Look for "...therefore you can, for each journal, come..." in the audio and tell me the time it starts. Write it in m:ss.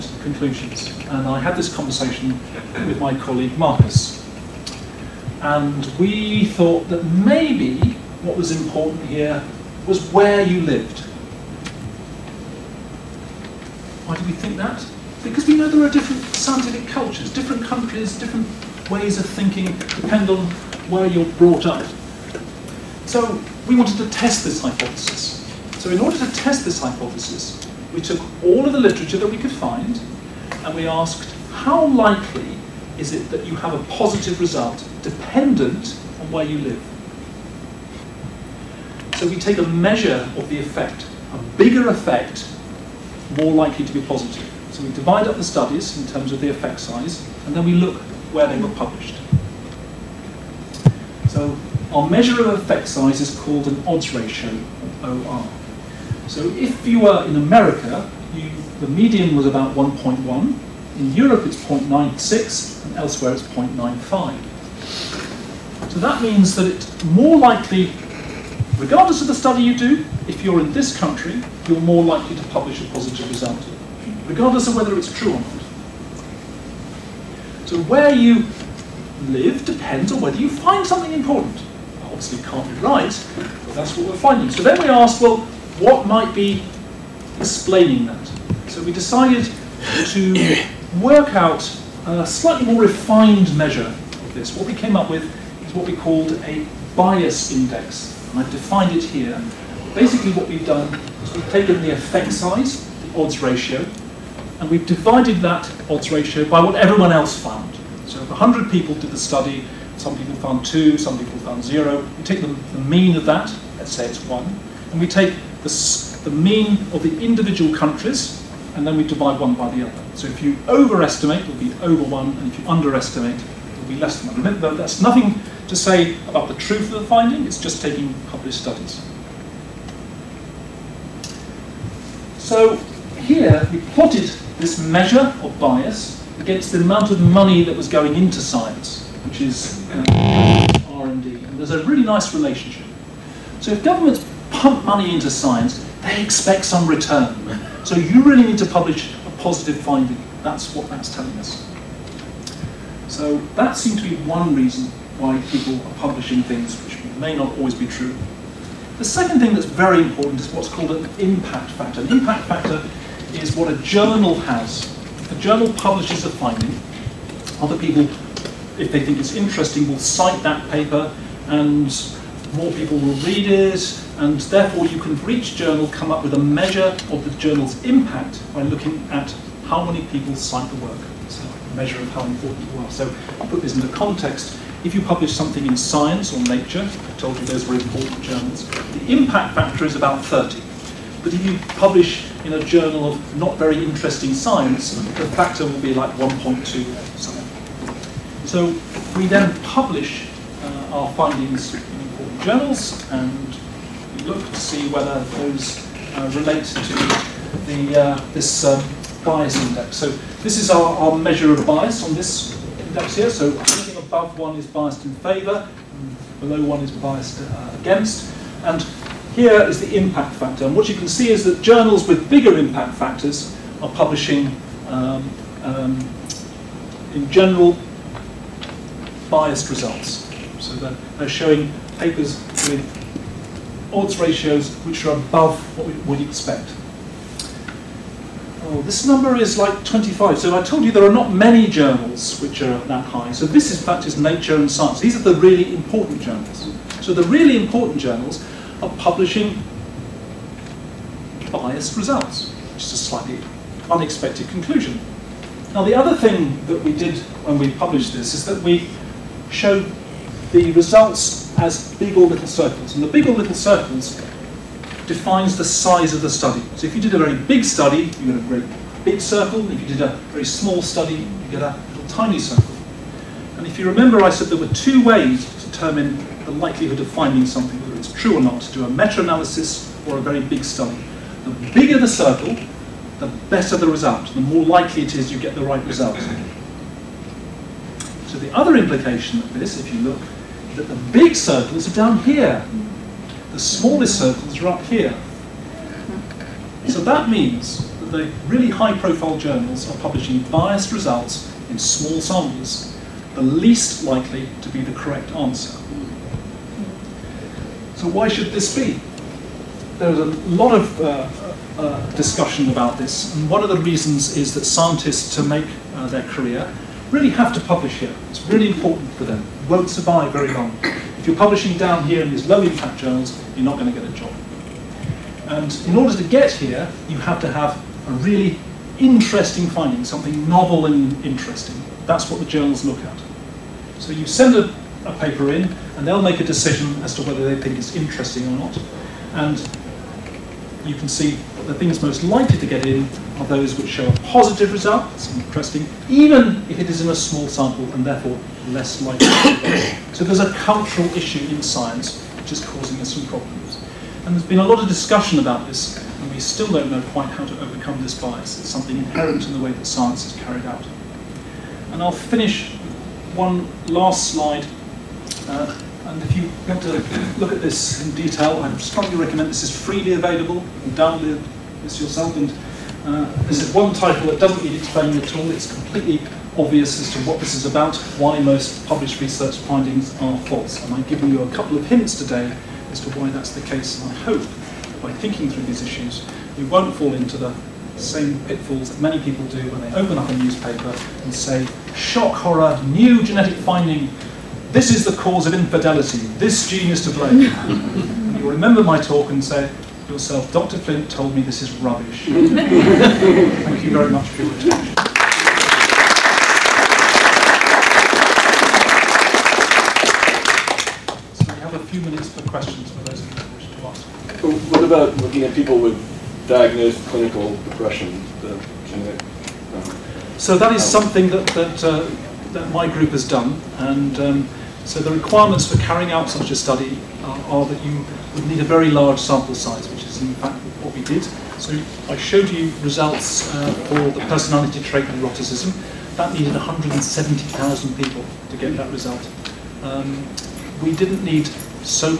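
2:54.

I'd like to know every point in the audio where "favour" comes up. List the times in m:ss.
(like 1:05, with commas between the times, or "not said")
3:35.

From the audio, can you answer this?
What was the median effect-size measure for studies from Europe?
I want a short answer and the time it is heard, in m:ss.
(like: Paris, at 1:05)
0.96, at 1:01.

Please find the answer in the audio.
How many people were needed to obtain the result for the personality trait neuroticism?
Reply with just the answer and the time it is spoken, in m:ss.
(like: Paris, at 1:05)
170,000, at 7:16.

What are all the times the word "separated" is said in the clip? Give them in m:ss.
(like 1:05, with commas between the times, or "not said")
not said.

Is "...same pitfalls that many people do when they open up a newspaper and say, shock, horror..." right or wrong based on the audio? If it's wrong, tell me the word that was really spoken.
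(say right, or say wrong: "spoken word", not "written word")
right.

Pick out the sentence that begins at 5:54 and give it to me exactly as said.
And there's been a lot of discussion about this, and we still don't know quite how to overcome this bias.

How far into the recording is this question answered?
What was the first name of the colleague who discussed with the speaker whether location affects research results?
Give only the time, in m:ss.
0:03.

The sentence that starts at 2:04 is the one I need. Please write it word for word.
that's nothing to say about the truth of the finding, it's just taking published studies.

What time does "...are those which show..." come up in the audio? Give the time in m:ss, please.
5:43.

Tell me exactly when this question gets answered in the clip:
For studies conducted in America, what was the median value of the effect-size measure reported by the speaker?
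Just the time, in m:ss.
0:59.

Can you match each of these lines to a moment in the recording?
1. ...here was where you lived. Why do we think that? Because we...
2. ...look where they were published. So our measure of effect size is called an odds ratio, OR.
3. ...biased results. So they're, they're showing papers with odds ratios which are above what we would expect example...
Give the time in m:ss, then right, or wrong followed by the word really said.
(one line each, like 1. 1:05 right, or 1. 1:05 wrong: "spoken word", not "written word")
1. 0:09 right
2. 0:47 right
3. 3:49 right.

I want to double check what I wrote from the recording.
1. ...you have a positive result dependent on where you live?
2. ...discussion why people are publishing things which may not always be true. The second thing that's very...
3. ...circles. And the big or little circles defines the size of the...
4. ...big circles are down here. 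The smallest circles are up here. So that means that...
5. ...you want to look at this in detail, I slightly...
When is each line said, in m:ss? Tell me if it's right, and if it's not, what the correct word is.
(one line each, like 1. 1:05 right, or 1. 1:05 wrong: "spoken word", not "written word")
1. 0:33 right
2. 2:34 wrong: "reason", not "discussion"
3. 4:22 right
4. 4:51 right
5. 6:06 wrong: "strongly", not "slightly".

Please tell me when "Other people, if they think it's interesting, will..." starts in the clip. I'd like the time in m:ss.
2:47.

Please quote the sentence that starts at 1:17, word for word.
So where you live depends on whether you find something important.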